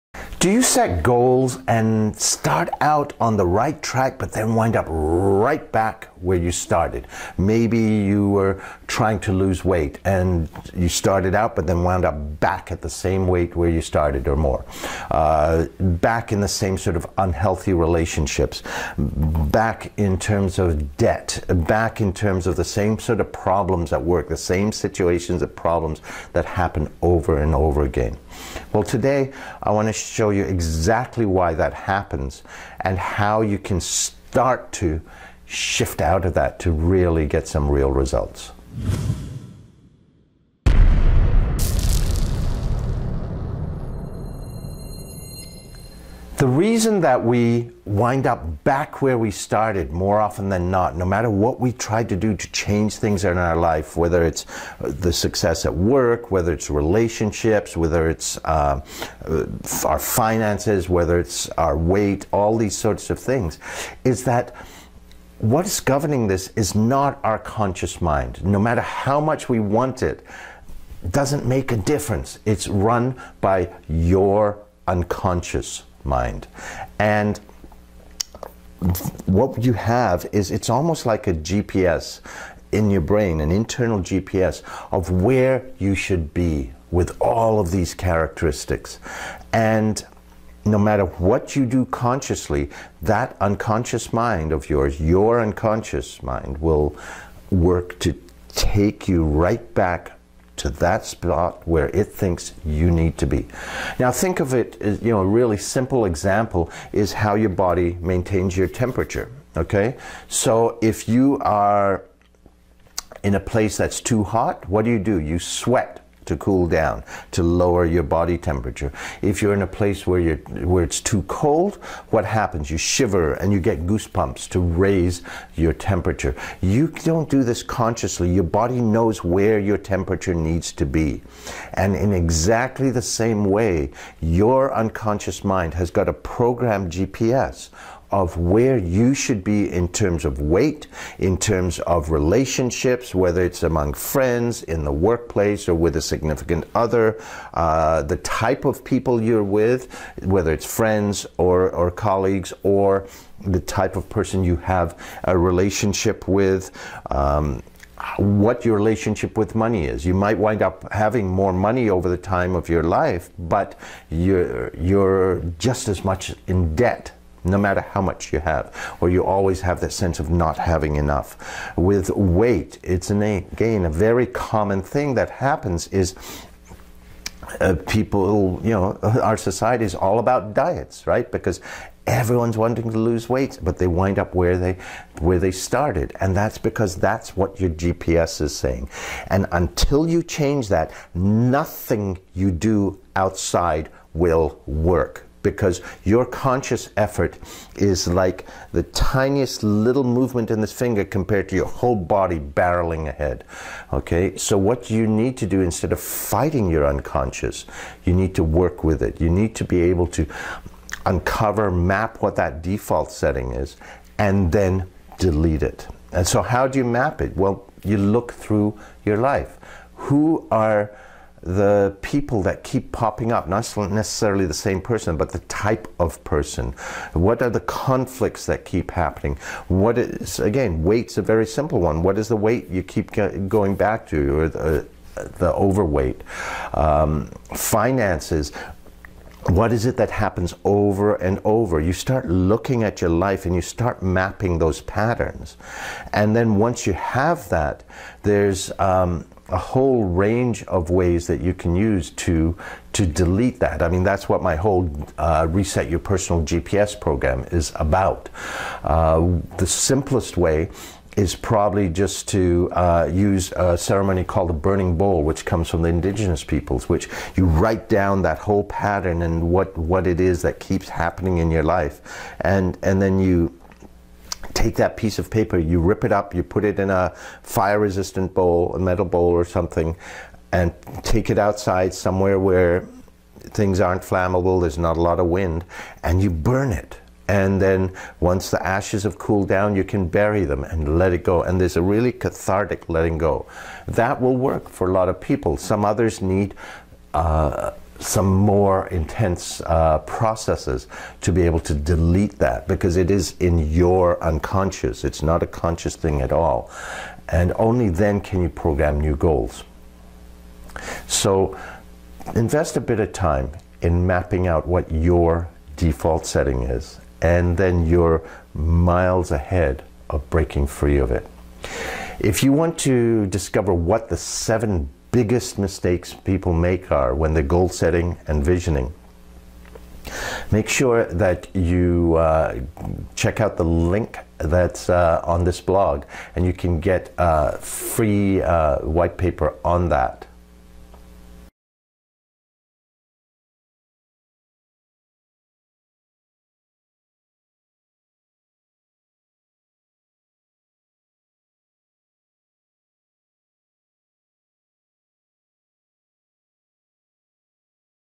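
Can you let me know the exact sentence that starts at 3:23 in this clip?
Okay, so what you need to do instead of fighting your unconscious, you need to work with it.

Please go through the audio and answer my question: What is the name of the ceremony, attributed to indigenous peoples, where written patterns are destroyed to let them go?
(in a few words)
burning bowl.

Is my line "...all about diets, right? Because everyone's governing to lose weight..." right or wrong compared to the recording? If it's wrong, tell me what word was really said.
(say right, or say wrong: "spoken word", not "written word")
wrong: "wanting", not "governing".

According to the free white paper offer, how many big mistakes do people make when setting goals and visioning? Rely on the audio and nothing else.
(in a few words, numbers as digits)
7.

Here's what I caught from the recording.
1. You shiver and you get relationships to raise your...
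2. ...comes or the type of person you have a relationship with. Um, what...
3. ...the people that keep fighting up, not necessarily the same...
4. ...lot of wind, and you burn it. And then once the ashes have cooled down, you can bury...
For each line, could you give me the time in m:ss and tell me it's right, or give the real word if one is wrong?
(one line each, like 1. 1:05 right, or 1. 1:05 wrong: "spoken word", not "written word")
1. 2:02 wrong: "goosebumps", not "relationships"
2. 2:31 wrong: "colleagues", not "comes"
3. 3:41 wrong: "popping", not "fighting"
4. 4:45 right.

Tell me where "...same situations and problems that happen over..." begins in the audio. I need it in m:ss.
0:24.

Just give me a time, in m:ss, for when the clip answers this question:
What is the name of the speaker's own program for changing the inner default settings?
4:15.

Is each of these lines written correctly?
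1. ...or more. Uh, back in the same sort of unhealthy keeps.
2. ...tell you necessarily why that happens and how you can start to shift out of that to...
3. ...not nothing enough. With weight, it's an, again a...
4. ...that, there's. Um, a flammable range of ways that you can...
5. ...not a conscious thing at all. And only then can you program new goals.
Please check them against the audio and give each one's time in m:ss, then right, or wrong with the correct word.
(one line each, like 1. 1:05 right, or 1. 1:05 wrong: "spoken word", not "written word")
1. 0:14 wrong: "relationships", not "keeps"
2. 0:30 wrong: "exactly", not "necessarily"
3. 2:50 wrong: "having", not "nothing"
4. 4:07 wrong: "whole", not "flammable"
5. 5:05 right.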